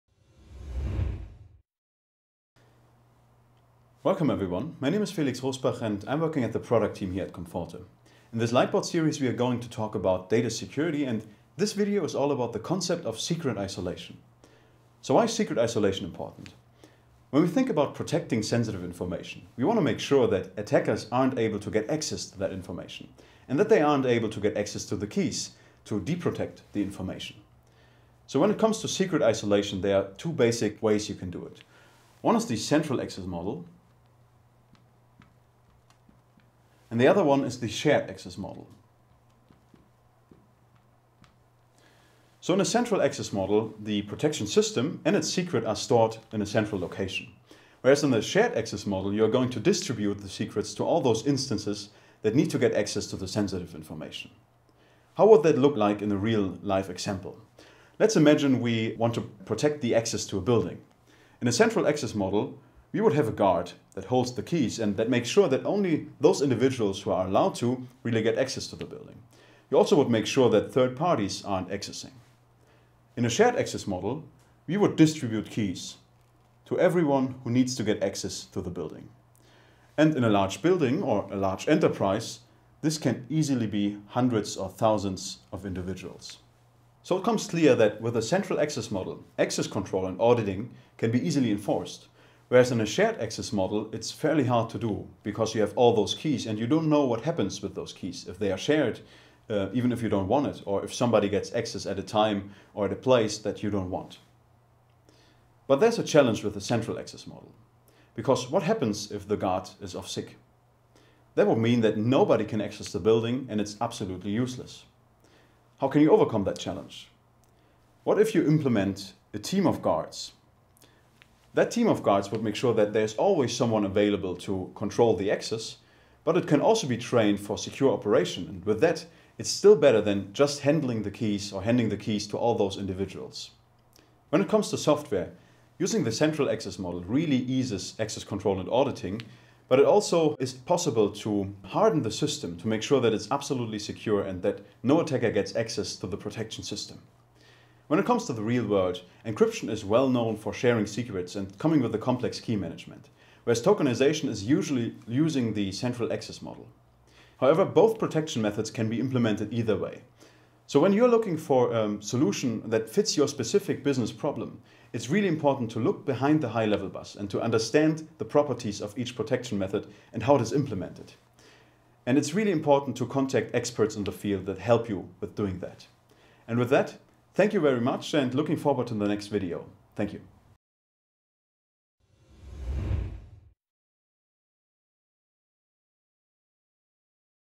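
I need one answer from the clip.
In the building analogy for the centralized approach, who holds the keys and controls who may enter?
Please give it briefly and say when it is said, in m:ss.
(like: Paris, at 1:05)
A guard, at 1:03.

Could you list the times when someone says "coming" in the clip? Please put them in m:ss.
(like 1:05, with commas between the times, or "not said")
2:31.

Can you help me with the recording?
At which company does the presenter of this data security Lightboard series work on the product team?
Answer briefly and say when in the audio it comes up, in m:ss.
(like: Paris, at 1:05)
comforte, at 0:07.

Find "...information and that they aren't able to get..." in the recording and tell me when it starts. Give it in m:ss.
0:22.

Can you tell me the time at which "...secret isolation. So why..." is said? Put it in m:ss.
0:13.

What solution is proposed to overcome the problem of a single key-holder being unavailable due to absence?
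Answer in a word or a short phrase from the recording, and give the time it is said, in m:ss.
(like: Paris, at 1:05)
A team of guards, at 1:59.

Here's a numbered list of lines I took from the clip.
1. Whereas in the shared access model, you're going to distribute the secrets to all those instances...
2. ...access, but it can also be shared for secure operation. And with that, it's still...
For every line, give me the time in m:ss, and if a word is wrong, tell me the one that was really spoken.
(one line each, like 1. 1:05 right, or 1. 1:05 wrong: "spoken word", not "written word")
1. 0:47 right
2. 2:05 wrong: "trained", not "shared".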